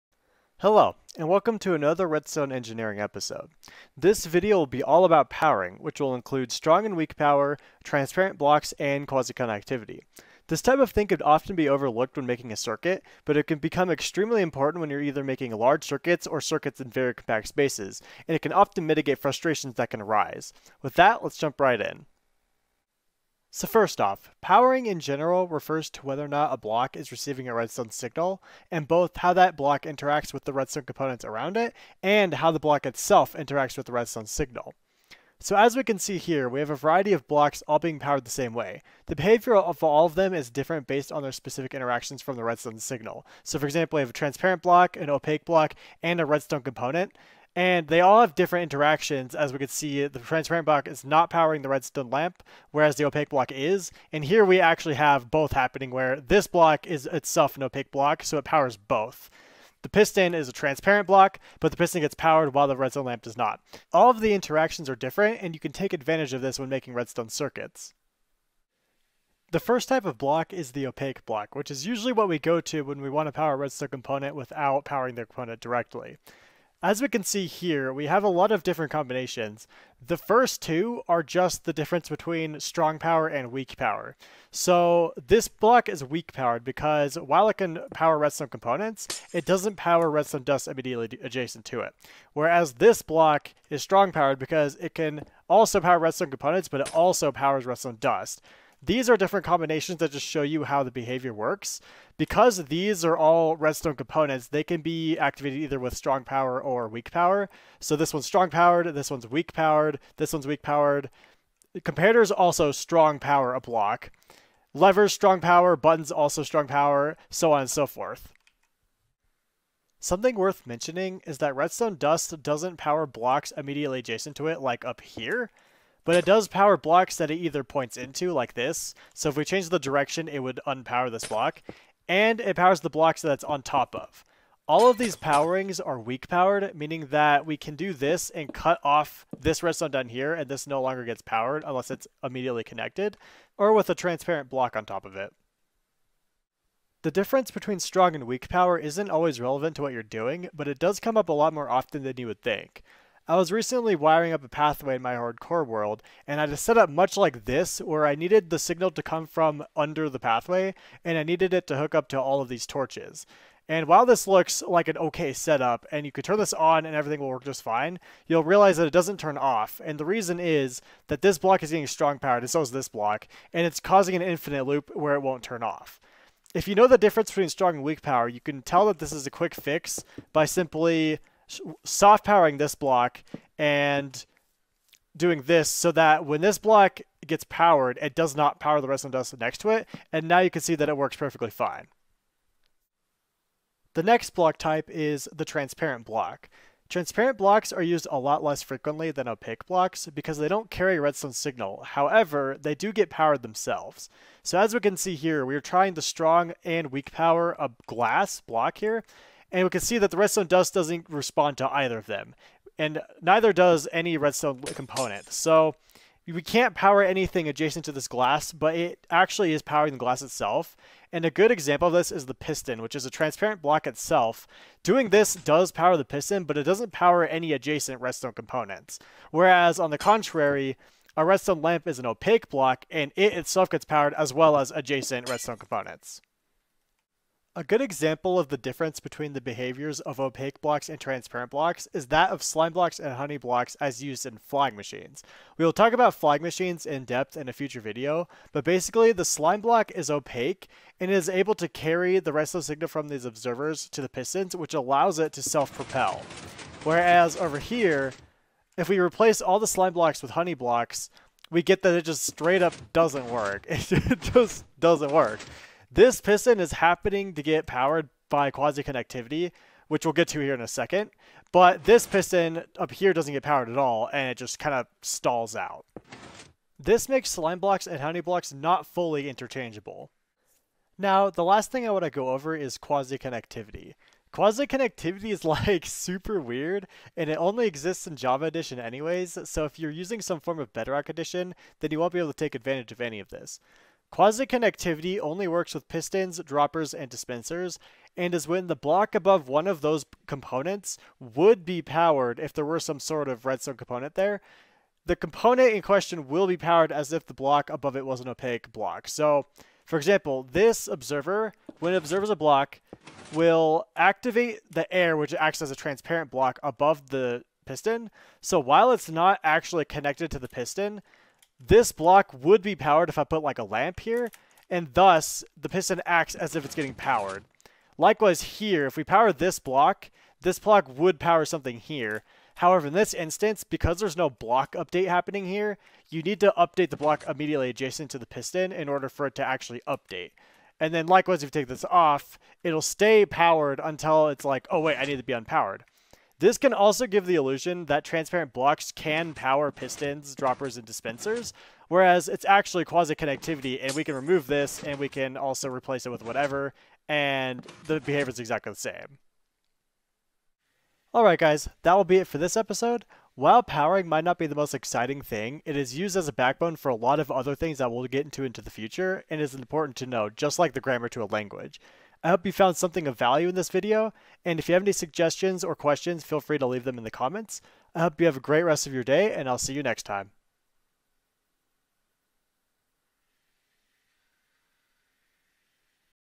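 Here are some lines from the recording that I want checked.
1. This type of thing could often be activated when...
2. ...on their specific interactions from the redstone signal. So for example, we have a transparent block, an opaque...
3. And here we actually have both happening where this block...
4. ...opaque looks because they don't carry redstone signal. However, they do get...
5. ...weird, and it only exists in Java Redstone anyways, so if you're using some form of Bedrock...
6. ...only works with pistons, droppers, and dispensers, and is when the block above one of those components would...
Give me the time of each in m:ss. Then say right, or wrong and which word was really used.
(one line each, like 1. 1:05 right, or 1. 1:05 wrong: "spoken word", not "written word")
1. 0:10 wrong: "overlooked", not "activated"
2. 0:41 right
3. 0:54 right
4. 3:19 wrong: "blocks", not "looks"
5. 4:46 wrong: "Edition", not "Redstone"
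6. 4:55 right.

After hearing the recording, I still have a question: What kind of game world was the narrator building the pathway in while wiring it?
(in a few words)
Hardcore world.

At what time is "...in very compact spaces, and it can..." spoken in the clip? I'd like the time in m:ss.
0:16.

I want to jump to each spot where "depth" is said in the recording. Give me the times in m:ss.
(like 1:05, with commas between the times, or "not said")
4:07.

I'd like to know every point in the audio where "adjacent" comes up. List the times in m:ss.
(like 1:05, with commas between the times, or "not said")
1:31, 2:03, 3:37, 3:47, 3:54, 5:37.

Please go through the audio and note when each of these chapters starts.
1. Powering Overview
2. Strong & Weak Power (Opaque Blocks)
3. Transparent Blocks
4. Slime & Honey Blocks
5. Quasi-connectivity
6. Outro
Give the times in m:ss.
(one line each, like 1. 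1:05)
1. 0:22
2. 1:08
3. 3:13
4. 3:57
5. 4:40
6. 6:00.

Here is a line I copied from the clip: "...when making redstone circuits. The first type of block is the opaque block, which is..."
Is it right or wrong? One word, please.
right.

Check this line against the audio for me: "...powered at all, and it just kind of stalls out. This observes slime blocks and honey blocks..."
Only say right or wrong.
wrong.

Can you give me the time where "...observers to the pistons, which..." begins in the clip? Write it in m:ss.
4:13.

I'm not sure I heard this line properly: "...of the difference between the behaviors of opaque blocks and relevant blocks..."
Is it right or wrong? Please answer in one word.
wrong.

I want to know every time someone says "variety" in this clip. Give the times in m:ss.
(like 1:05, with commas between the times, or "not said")
0:36.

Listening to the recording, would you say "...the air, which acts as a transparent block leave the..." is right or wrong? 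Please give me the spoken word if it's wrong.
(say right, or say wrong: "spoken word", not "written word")
wrong: "above", not "leave".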